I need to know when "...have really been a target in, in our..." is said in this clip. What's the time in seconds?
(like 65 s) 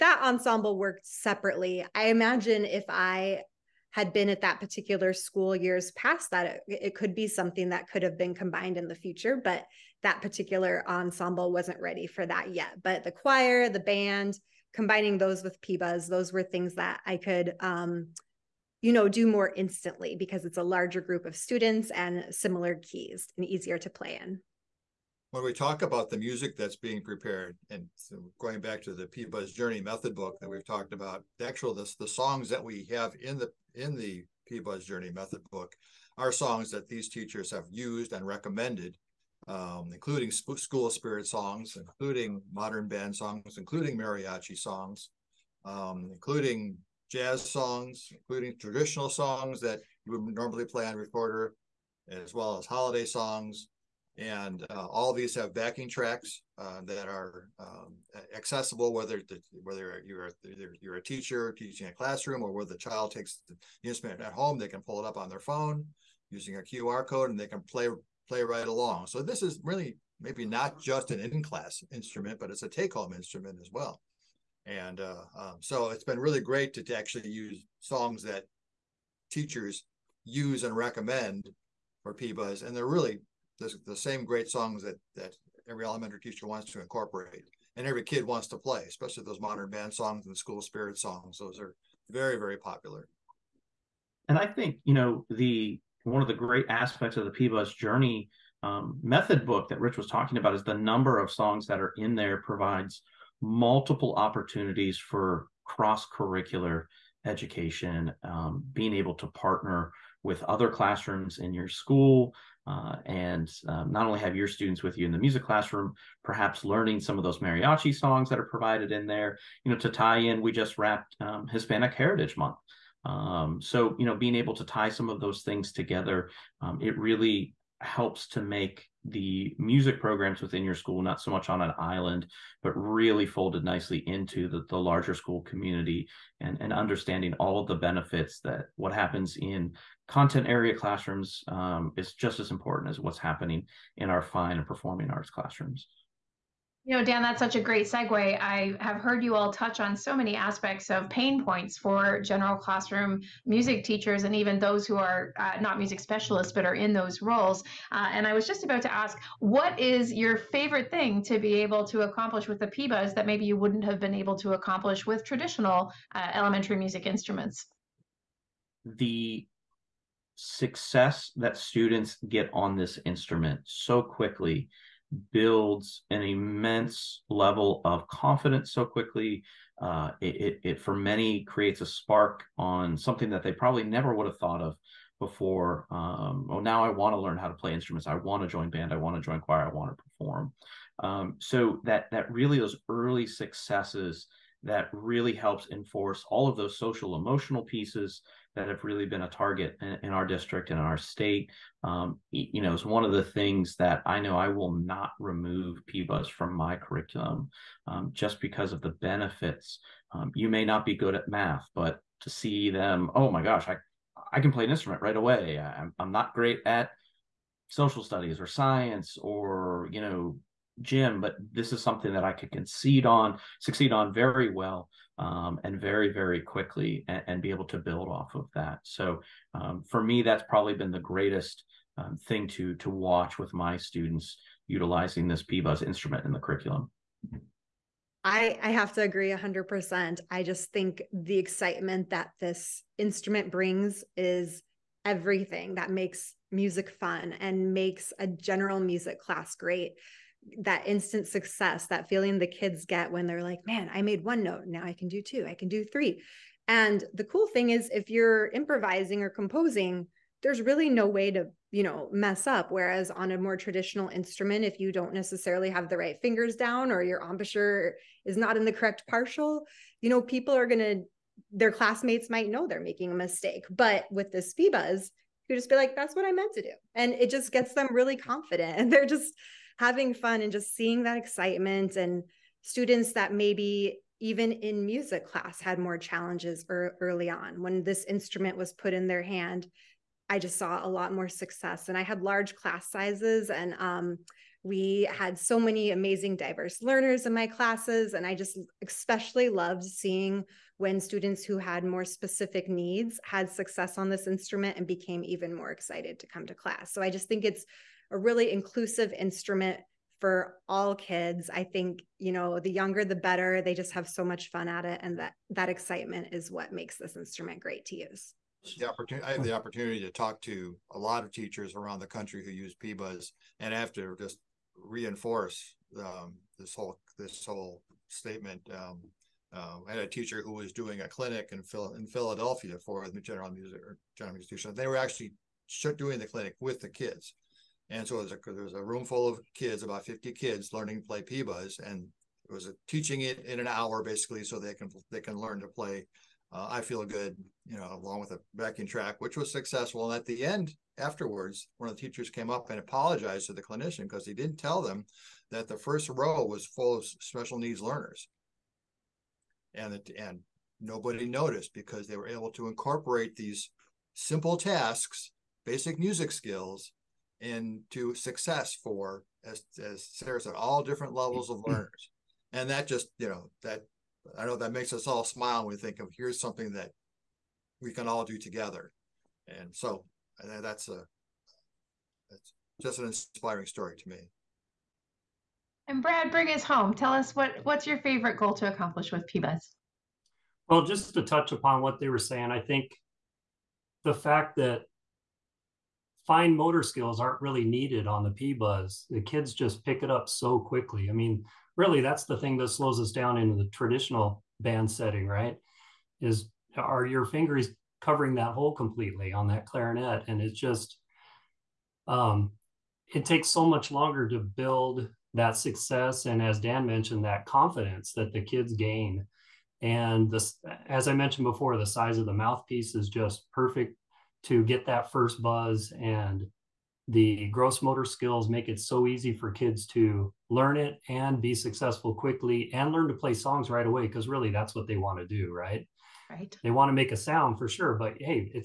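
198 s.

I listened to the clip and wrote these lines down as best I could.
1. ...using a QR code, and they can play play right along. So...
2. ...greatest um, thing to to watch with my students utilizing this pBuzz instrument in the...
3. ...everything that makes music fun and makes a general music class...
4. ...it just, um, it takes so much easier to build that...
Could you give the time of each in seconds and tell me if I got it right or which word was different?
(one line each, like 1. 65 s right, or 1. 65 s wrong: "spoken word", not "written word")
1. 66 s right
2. 230 s right
3. 245 s right
4. 410 s wrong: "longer", not "easier".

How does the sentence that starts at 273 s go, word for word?
But with this pBuzz, you just be like, that's what I meant to do.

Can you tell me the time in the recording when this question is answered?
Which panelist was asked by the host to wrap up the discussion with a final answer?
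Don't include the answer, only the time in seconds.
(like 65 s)
386 s.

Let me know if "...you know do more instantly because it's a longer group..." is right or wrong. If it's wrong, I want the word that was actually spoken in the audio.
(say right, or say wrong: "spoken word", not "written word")
wrong: "larger", not "longer".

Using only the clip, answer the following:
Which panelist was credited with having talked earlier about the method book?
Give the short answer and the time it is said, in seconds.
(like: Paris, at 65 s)
Rich, at 99 s.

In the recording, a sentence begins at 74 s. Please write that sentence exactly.
And uh, um, so it's been really great to, to, actually use songs that teachers use and recommend for pBuzz.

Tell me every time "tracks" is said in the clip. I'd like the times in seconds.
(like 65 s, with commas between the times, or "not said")
55 s, 348 s.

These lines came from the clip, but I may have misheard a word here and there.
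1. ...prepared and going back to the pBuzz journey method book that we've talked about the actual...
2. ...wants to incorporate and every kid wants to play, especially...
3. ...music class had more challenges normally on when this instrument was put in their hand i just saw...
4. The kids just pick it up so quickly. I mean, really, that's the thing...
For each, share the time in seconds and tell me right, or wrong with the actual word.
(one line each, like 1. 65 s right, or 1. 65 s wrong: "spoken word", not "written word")
1. 27 s right
2. 86 s right
3. 284 s wrong: "early", not "normally"
4. 399 s right.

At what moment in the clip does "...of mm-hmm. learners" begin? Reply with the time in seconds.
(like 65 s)
371 s.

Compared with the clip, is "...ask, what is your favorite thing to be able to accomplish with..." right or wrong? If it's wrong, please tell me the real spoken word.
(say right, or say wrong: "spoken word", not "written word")
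right.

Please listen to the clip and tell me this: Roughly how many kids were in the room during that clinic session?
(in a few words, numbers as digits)
50.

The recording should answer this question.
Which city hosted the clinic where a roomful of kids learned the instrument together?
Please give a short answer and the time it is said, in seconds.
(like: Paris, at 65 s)
Philadelphia, at 332 s.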